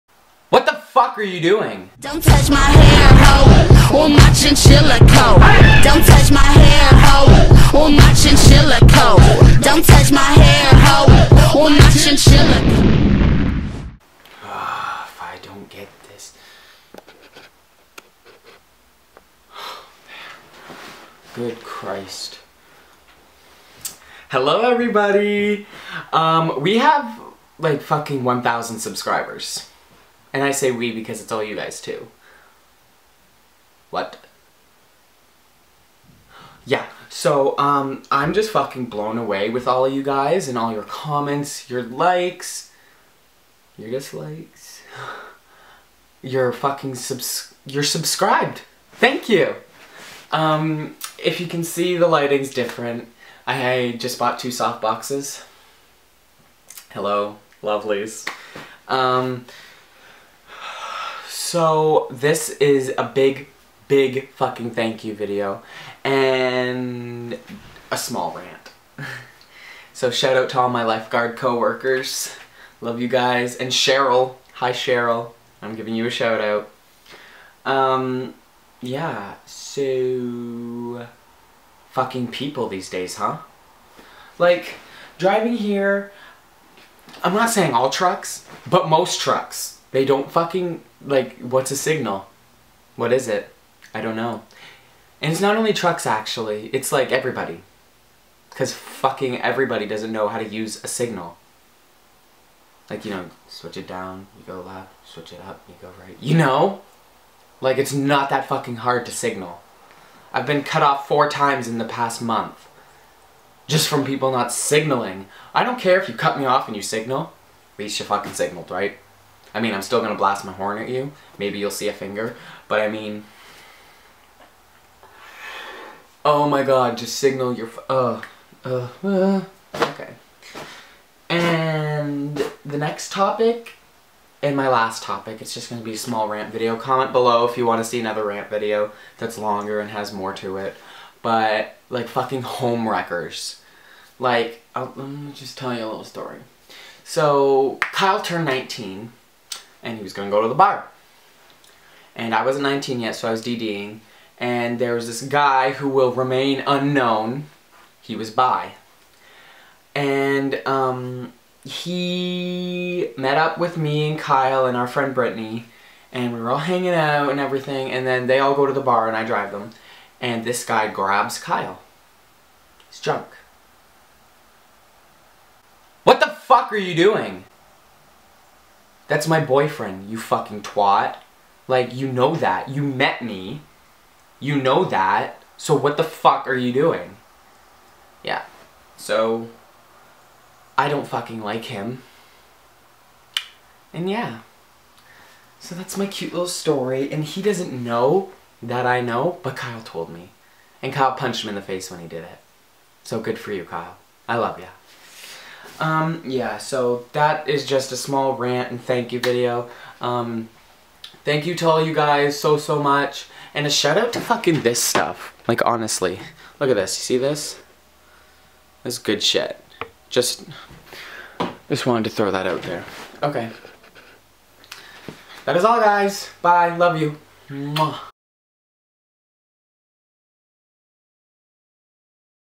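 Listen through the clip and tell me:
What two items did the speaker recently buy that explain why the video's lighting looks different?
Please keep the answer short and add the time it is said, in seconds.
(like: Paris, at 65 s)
soft boxes, at 54 s.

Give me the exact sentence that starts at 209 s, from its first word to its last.
Um, thank you to all you guys so, so much.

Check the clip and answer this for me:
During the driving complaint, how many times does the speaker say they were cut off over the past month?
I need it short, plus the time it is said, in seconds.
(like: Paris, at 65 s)
4, at 111 s.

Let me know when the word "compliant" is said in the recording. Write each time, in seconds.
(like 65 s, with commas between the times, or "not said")
not said.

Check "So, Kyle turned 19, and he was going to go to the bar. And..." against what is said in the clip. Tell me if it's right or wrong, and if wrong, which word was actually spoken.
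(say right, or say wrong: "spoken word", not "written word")
right.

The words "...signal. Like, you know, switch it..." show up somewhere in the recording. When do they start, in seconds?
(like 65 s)
100 s.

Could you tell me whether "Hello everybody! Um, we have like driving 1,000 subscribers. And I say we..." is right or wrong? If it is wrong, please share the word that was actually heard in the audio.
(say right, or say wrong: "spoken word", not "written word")
wrong: "fucking", not "driving".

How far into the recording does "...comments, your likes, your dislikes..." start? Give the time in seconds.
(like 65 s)
40 s.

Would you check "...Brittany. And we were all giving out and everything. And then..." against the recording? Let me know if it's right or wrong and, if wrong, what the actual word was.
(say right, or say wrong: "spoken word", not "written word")
wrong: "hanging", not "giving".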